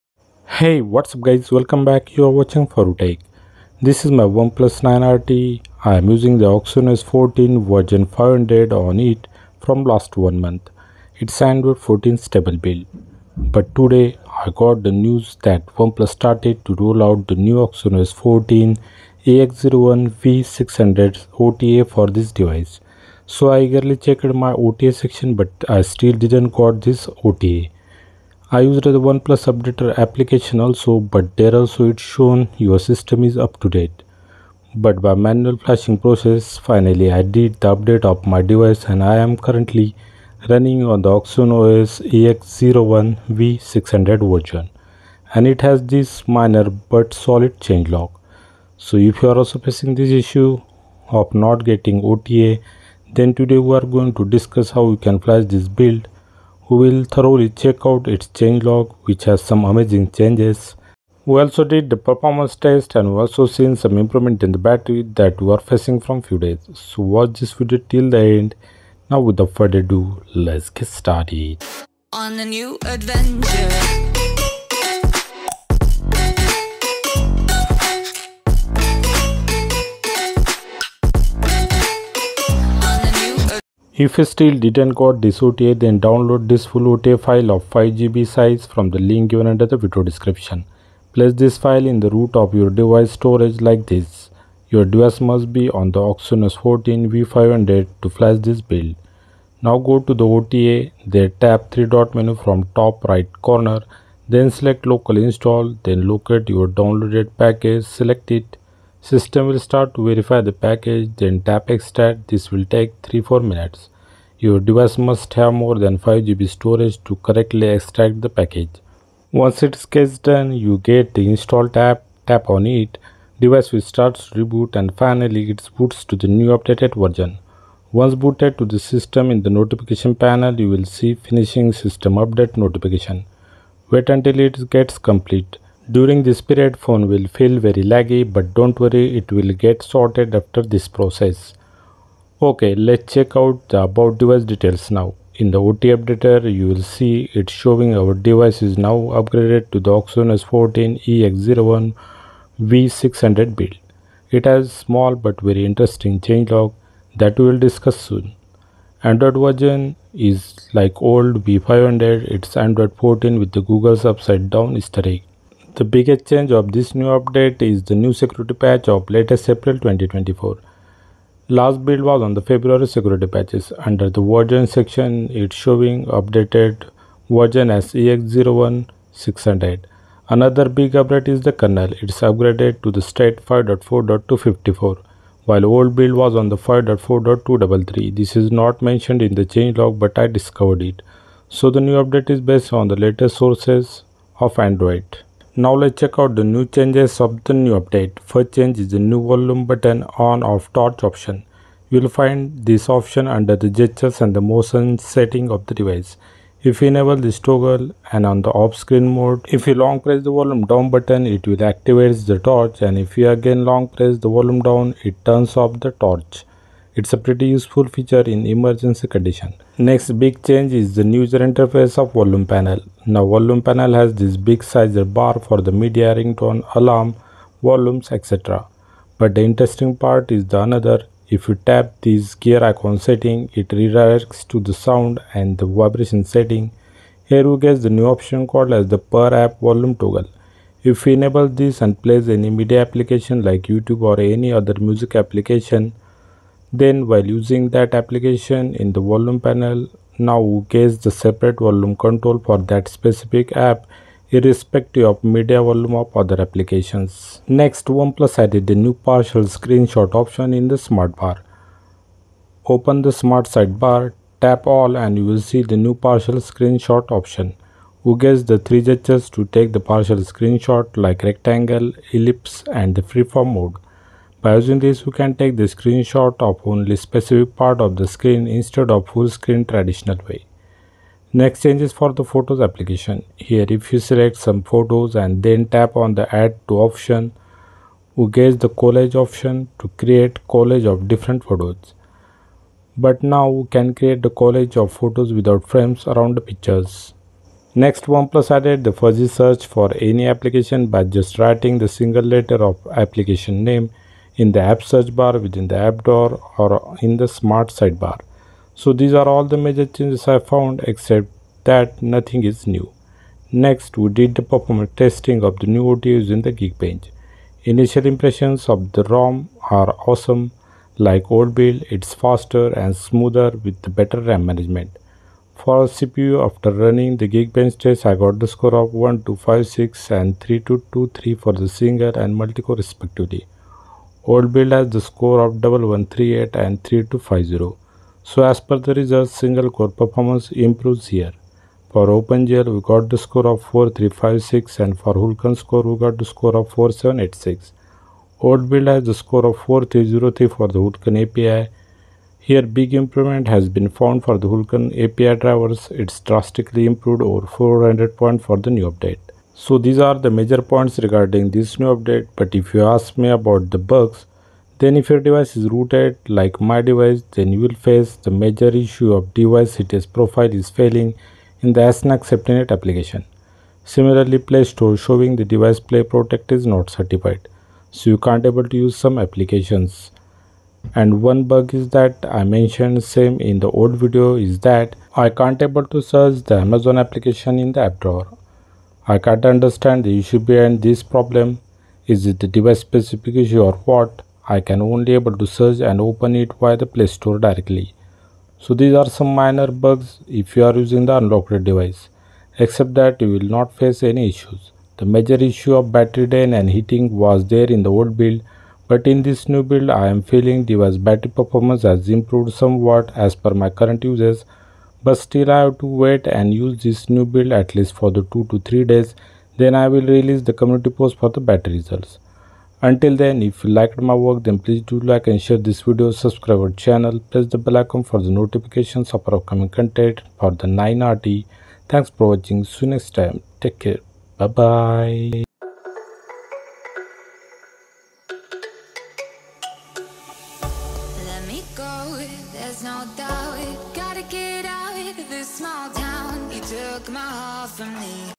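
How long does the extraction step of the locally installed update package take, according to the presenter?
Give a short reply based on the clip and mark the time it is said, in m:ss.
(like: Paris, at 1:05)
3-4 minutes, at 1:53.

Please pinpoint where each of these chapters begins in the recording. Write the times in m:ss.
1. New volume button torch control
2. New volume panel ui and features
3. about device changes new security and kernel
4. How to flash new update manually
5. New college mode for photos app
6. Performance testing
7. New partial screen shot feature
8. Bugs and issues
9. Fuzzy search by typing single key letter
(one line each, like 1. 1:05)
1. 3:15
2. 3:39
3. 2:21
4. 1:23
5. 4:42
6. 5:15
7. 4:17
8. 5:59
9. 4:57.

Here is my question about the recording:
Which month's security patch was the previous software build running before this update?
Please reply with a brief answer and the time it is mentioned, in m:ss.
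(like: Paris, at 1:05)
February, at 2:52.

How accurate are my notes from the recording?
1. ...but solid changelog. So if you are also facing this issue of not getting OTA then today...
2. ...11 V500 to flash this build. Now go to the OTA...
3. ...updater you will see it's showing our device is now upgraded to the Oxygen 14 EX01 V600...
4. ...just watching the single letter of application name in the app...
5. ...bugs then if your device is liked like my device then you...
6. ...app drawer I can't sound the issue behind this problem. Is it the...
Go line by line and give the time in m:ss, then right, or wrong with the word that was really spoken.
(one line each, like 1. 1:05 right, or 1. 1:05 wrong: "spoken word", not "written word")
1. 0:46 right
2. 1:36 wrong: "14", not "11"
3. 2:25 right
4. 5:01 wrong: "writing", not "watching"
5. 6:03 wrong: "rooted", not "liked"
6. 6:27 wrong: "understand", not "sound".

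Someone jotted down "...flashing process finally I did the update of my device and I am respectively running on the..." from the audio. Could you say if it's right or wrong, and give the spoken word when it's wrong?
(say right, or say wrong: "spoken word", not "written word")
wrong: "currently", not "respectively".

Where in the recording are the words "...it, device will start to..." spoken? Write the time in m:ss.
2:02.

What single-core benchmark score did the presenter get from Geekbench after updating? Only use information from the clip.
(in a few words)
1256.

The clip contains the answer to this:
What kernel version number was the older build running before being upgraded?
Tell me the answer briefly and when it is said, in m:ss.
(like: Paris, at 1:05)
5.4.233, at 3:06.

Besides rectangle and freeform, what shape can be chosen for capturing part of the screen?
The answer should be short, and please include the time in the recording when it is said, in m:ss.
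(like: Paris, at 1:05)
ellipse, at 4:32.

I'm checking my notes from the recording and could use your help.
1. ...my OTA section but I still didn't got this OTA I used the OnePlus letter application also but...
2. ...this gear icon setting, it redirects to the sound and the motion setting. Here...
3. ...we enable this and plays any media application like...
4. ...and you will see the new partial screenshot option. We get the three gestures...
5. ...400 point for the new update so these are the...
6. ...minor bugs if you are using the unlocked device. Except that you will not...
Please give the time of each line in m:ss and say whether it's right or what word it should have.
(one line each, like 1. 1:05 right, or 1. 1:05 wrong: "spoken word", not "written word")
1. 0:24 wrong: "updater", not "letter"
2. 3:52 wrong: "vibration", not "motion"
3. 4:01 right
4. 4:24 right
5. 5:57 right
6. 6:39 right.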